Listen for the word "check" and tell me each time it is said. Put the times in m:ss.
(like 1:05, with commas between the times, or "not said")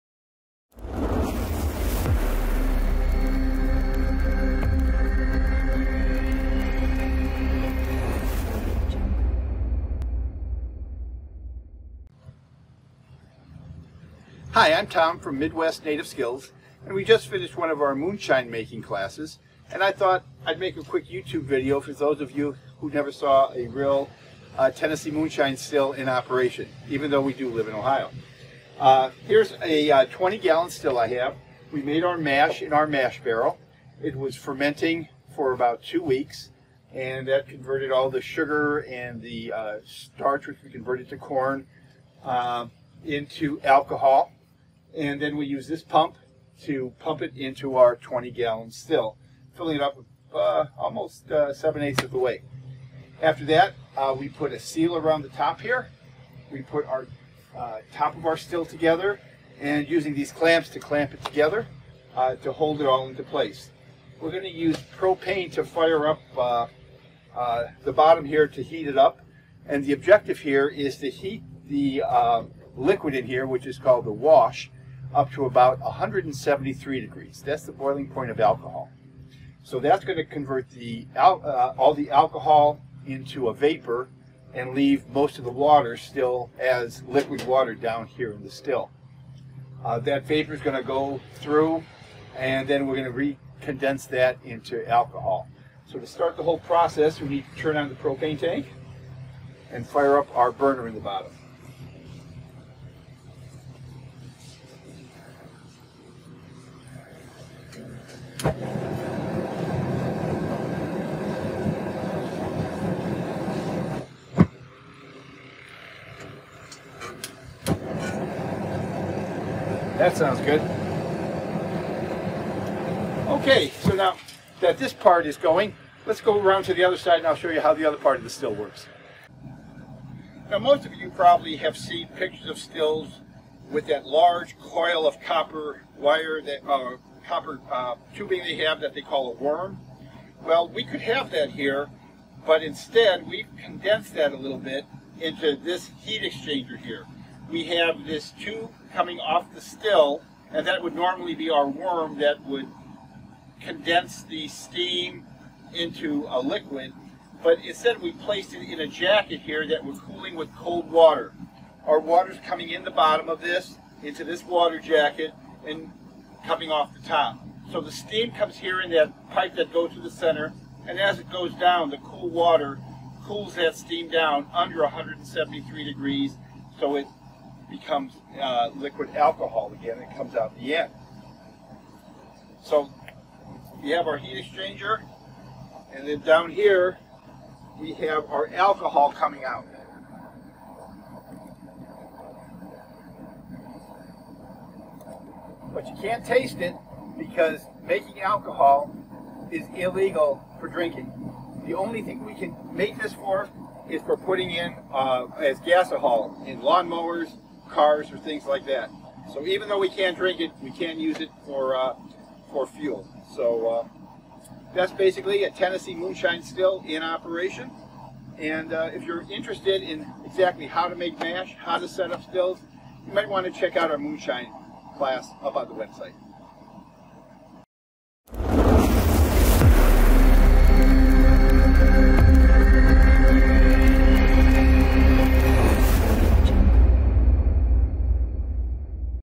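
3:43.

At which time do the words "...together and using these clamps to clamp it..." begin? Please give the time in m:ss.
0:58.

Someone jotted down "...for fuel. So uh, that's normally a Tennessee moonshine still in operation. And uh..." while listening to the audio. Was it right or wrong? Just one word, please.
wrong.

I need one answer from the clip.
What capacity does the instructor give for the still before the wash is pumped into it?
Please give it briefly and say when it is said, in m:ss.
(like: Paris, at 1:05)
20 gallons, at 0:30.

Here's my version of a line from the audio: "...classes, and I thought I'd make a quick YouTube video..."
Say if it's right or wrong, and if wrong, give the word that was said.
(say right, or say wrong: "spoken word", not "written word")
right.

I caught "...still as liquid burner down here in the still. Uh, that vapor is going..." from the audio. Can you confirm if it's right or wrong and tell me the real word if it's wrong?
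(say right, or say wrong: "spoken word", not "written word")
wrong: "water", not "burner".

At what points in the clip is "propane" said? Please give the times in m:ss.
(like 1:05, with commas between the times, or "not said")
1:04, 1:37.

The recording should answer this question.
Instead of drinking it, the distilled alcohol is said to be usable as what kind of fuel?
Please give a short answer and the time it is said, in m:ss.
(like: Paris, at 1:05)
gasohol, at 3:25.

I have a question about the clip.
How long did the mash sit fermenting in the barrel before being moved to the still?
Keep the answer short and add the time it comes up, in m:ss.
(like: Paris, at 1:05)
about two weeks, at 0:35.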